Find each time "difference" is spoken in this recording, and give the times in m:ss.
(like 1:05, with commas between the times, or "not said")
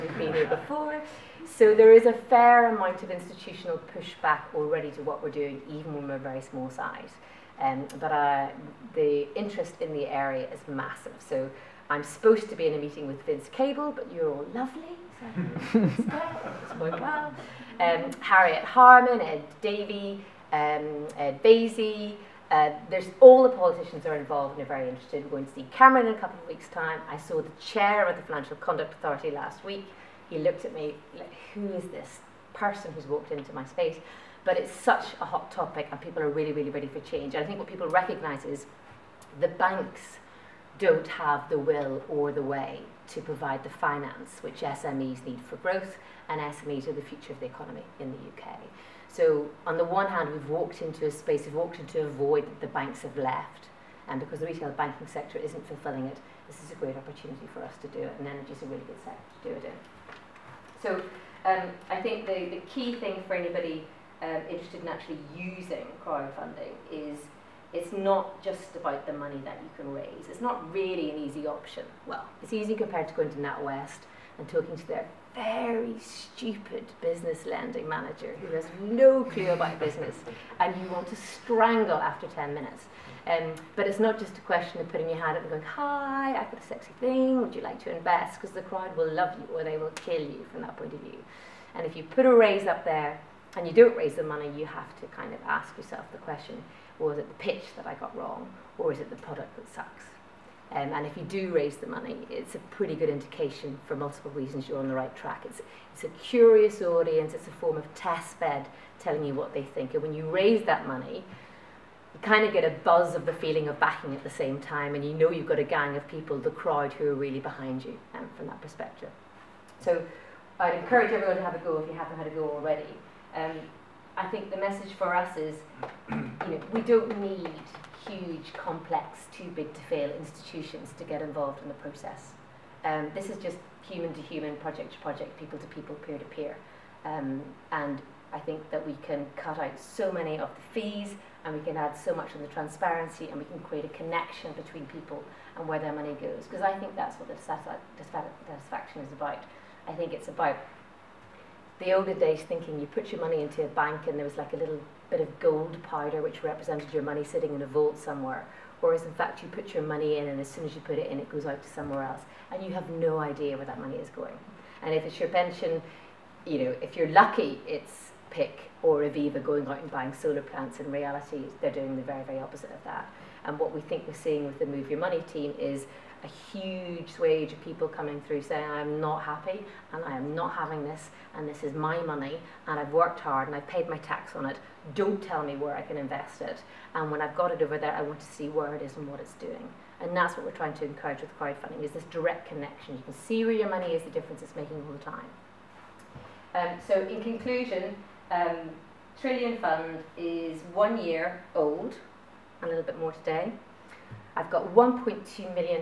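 3:14.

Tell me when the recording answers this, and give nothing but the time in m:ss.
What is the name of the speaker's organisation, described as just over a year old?
3:19.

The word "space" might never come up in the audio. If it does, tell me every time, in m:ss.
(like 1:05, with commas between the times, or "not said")
0:33, 0:51.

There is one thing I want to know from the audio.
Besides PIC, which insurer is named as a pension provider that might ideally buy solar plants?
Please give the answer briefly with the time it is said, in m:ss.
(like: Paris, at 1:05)
Aviva, at 2:49.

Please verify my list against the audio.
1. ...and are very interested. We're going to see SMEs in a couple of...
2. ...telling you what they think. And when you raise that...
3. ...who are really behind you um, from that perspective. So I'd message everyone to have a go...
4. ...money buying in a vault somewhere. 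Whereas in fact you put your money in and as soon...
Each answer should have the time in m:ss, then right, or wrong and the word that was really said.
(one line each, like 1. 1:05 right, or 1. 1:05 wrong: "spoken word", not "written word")
1. 0:24 wrong: "Cameron", not "SMEs"
2. 1:49 right
3. 1:56 wrong: "encourage", not "message"
4. 2:37 wrong: "sitting", not "buying".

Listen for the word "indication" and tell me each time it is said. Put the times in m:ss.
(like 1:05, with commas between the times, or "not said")
1:43.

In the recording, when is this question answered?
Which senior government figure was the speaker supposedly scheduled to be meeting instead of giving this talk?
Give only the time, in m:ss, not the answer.
0:13.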